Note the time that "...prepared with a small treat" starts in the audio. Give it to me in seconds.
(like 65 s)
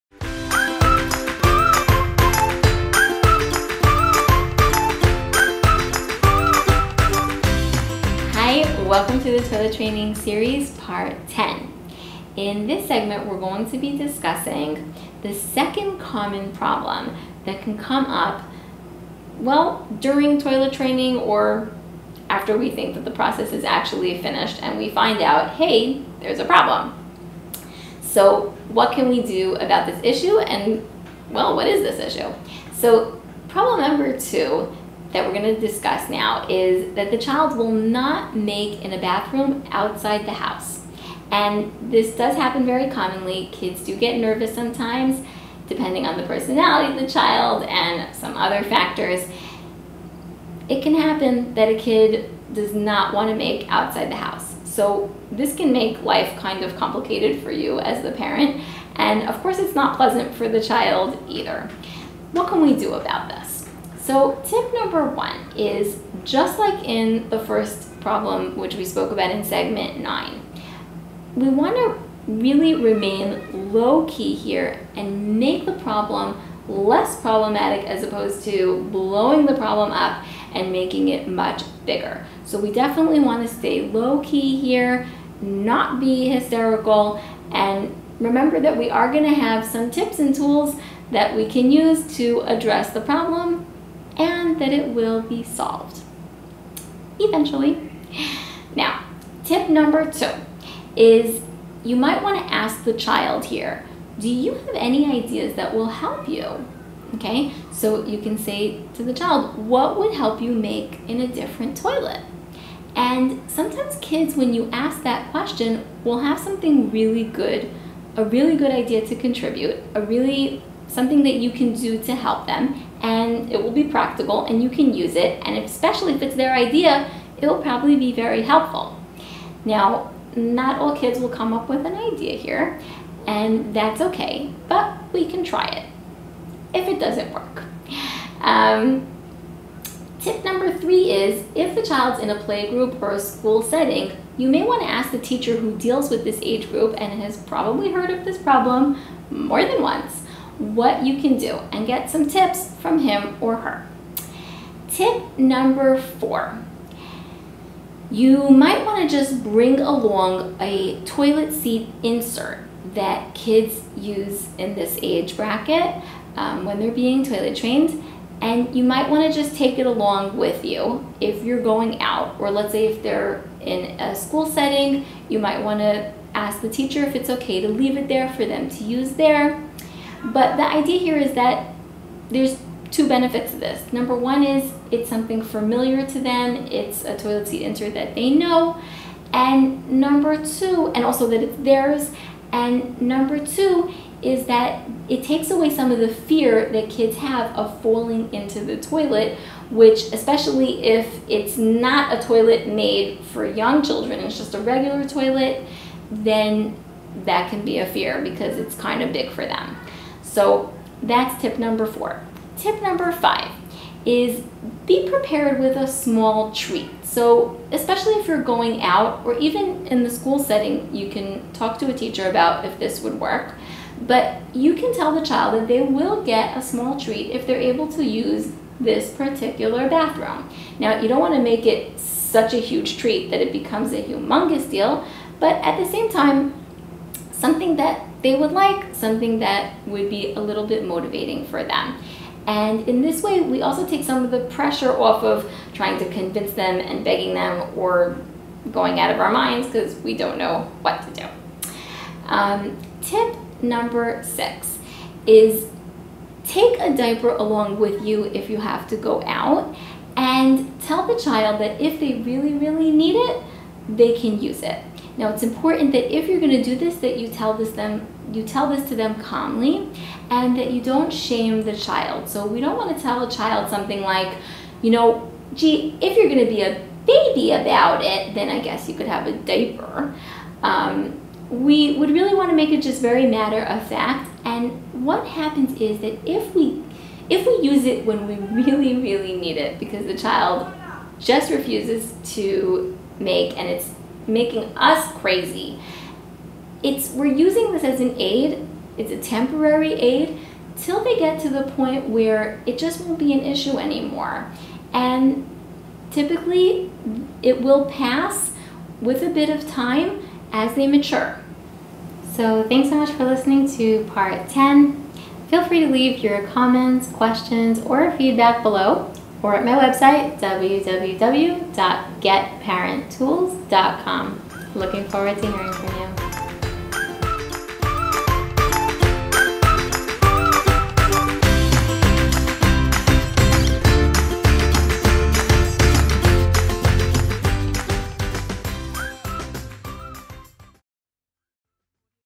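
215 s.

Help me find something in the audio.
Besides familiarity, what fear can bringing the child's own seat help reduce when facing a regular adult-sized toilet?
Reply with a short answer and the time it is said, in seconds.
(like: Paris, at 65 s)
Falling into the toilet, at 197 s.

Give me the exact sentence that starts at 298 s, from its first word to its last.
It's a temporary aid till they get to the point where it just won't be an issue anymore.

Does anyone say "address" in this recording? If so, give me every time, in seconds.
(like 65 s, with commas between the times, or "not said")
92 s.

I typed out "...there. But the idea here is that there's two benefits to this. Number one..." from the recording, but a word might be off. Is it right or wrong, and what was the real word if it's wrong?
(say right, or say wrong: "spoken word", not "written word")
right.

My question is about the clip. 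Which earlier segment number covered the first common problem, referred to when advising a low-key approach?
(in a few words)
9.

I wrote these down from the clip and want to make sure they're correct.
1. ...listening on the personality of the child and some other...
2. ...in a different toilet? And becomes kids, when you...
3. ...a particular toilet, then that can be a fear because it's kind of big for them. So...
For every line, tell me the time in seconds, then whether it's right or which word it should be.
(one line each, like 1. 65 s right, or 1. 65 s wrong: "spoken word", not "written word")
1. 45 s wrong: "depending", not "listening"
2. 111 s wrong: "sometimes", not "becomes"
3. 204 s wrong: "regular", not "particular".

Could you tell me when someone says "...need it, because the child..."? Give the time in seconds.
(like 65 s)
289 s.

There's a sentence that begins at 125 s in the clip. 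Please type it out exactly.
And especially if it's their idea, it will probably be very helpful.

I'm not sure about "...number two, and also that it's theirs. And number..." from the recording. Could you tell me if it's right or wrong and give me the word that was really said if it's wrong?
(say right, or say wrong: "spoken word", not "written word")
right.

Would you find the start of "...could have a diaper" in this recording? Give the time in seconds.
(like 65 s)
278 s.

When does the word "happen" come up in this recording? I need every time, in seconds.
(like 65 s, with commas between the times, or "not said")
42 s, 50 s, 285 s.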